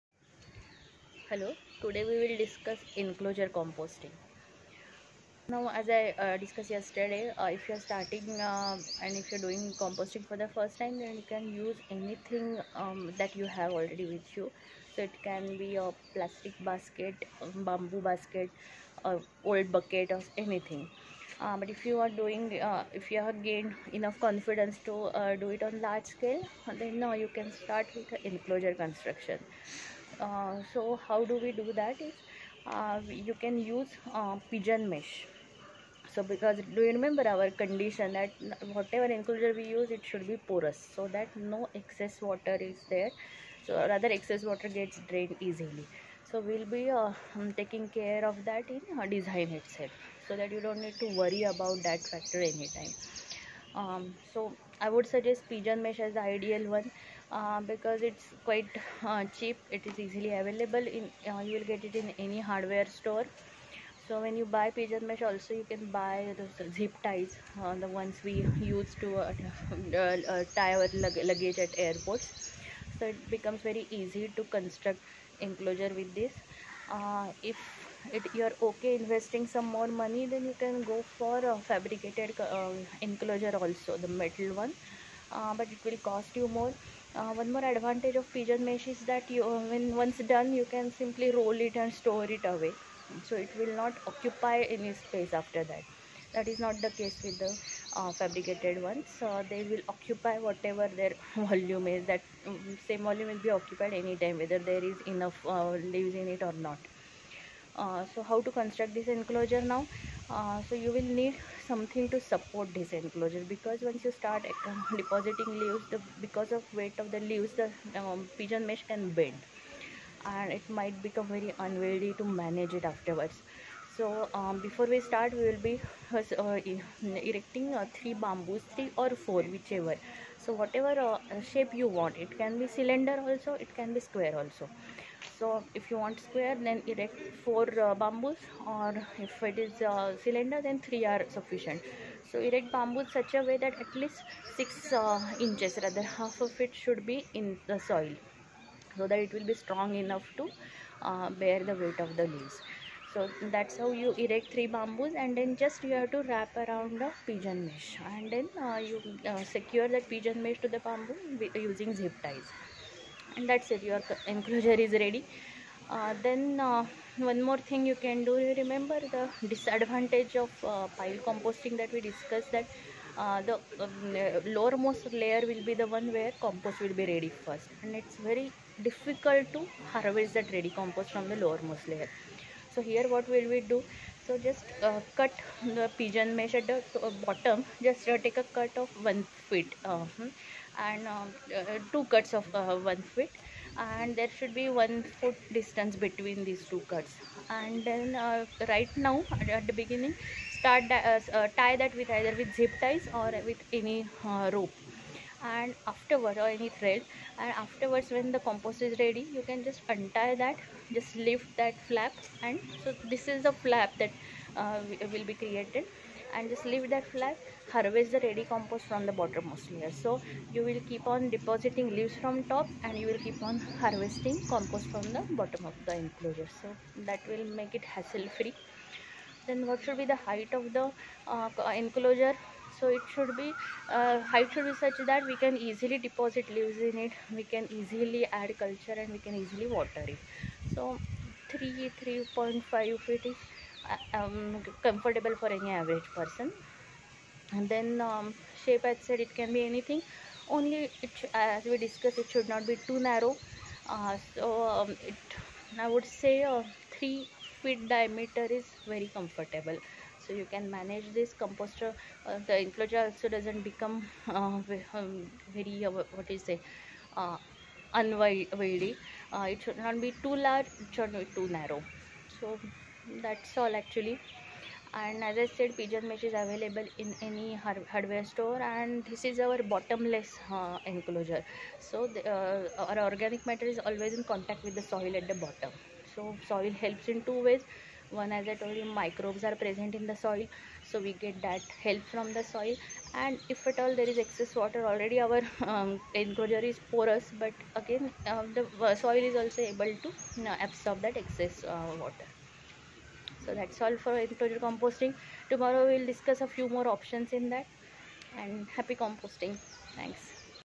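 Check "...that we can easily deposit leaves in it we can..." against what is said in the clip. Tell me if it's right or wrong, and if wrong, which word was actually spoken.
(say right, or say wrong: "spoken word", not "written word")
right.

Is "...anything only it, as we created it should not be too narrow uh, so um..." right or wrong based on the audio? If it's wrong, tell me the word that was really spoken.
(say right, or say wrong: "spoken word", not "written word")
wrong: "discussed", not "created".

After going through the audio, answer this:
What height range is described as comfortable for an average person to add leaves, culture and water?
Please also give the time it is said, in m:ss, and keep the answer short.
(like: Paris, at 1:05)
3 to 3.5 feet, at 4:01.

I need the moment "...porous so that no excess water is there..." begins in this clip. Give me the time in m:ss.
0:40.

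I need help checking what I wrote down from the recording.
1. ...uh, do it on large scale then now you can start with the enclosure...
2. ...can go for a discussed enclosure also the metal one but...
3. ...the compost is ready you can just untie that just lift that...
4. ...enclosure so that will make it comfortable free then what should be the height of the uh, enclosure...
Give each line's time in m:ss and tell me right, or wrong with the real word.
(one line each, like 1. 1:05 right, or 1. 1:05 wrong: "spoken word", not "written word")
1. 0:25 right
2. 1:20 wrong: "fabricated", not "discussed"
3. 3:28 right
4. 3:46 wrong: "hassle", not "comfortable".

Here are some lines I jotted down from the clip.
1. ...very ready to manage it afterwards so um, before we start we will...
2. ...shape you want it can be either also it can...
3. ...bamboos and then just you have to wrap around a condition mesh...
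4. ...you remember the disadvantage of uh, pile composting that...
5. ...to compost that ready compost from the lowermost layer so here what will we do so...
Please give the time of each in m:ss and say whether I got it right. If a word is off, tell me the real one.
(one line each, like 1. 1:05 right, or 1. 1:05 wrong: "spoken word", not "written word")
1. 2:01 wrong: "unwieldy", not "ready"
2. 2:11 wrong: "cylinder", not "either"
3. 2:34 wrong: "pigeon", not "condition"
4. 2:48 right
5. 2:59 wrong: "harvest", not "compost".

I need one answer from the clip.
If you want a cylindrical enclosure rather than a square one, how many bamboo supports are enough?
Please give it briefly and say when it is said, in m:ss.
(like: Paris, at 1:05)
3, at 2:20.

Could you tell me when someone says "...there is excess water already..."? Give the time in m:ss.
4:53.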